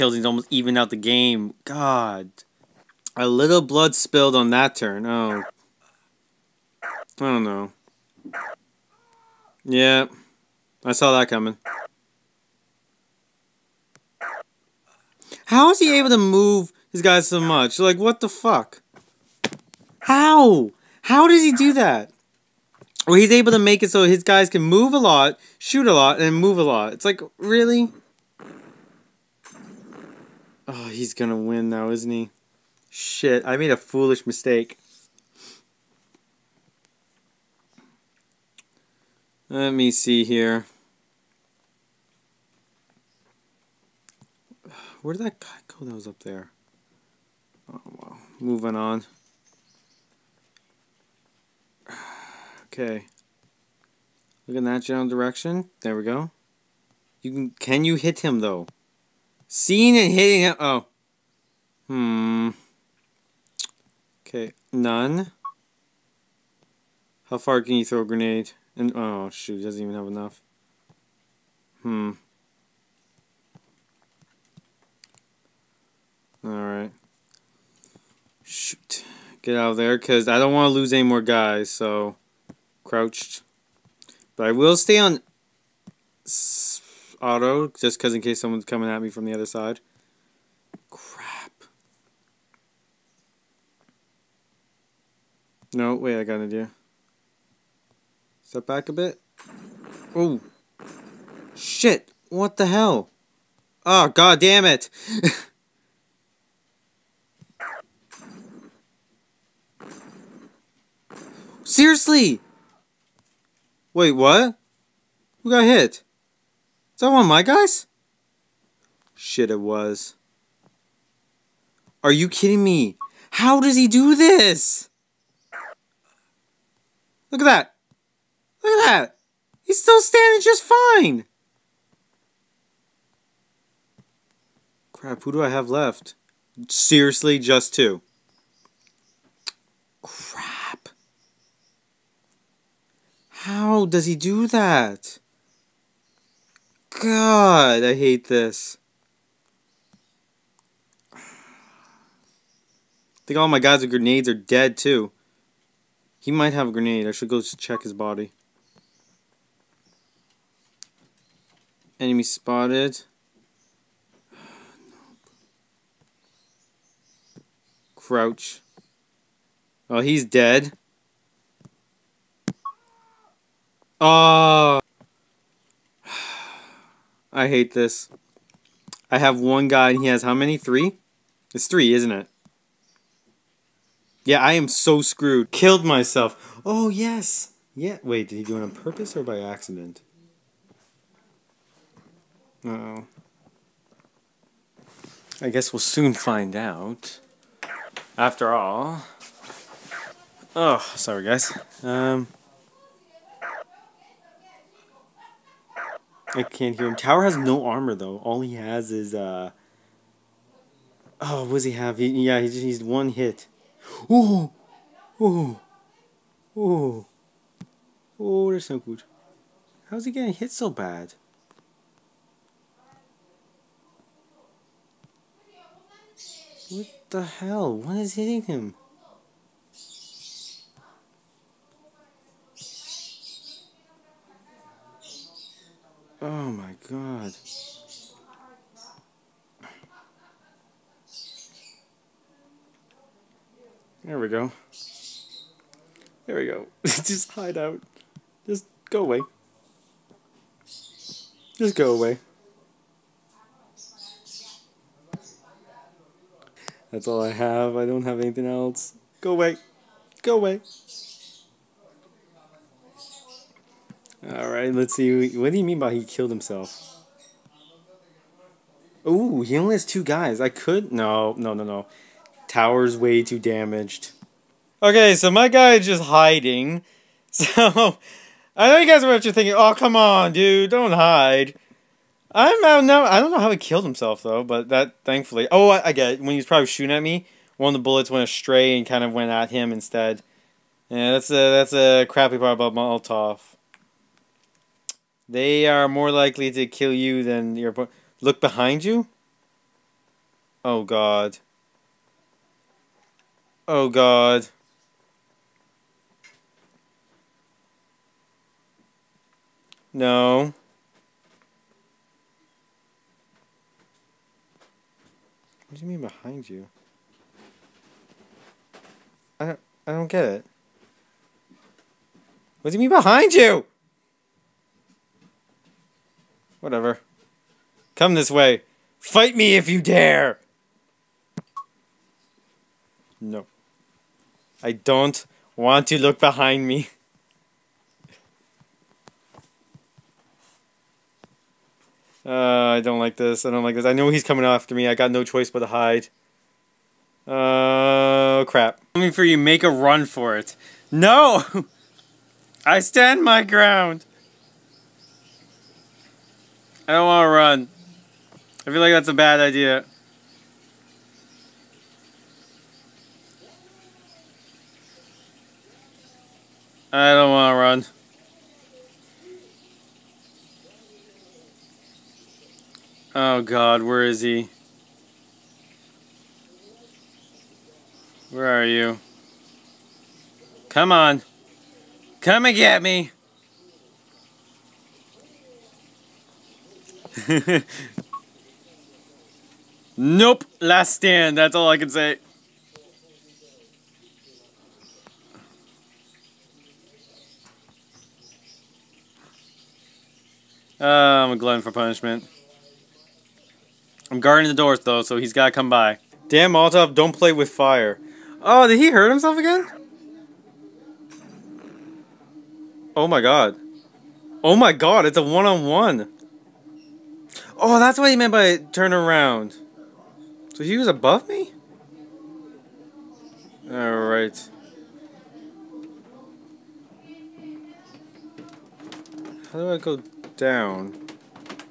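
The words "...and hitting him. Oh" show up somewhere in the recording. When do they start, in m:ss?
0:59.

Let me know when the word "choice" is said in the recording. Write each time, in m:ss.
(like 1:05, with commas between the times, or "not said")
5:45.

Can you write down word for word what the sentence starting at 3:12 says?
Uh I guess we'll soon find out.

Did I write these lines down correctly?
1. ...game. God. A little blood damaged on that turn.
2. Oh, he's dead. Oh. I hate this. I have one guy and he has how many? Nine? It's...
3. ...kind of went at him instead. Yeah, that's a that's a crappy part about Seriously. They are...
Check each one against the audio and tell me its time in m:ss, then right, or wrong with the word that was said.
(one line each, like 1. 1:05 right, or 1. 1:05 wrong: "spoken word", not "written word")
1. 0:00 wrong: "spilled", not "damaged"
2. 2:49 wrong: "Three", not "Nine"
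3. 4:48 wrong: "Molotov", not "Seriously".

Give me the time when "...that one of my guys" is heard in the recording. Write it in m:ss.
1:57.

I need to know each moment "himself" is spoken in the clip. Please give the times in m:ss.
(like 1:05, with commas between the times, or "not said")
4:26, 4:43, 6:49.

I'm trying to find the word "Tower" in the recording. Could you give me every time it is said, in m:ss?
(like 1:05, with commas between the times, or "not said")
3:26, 4:32.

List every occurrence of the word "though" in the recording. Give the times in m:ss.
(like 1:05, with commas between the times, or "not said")
0:58, 3:27, 4:44, 6:44.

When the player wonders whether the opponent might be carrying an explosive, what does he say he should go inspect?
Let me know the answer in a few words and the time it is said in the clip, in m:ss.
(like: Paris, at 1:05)
His body, at 2:37.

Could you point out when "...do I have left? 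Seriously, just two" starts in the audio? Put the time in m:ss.
2:15.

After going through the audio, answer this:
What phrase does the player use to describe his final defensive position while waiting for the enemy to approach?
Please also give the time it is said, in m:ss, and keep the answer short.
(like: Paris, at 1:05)
Last stand, at 6:30.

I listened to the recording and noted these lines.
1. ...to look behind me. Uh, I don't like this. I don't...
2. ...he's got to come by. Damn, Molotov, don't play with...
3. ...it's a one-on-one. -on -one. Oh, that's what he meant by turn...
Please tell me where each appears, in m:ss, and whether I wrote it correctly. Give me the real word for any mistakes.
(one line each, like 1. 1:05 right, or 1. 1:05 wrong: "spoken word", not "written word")
1. 5:35 right
2. 6:45 right
3. 6:55 right.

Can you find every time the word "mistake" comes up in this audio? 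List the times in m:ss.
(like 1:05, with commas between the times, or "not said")
0:34.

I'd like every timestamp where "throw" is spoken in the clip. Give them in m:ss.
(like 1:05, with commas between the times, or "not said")
1:07.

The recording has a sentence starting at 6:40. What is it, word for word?
Uh, I'm a glutton for punishment.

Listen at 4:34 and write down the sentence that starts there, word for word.
Okay, so my guy is just hiding.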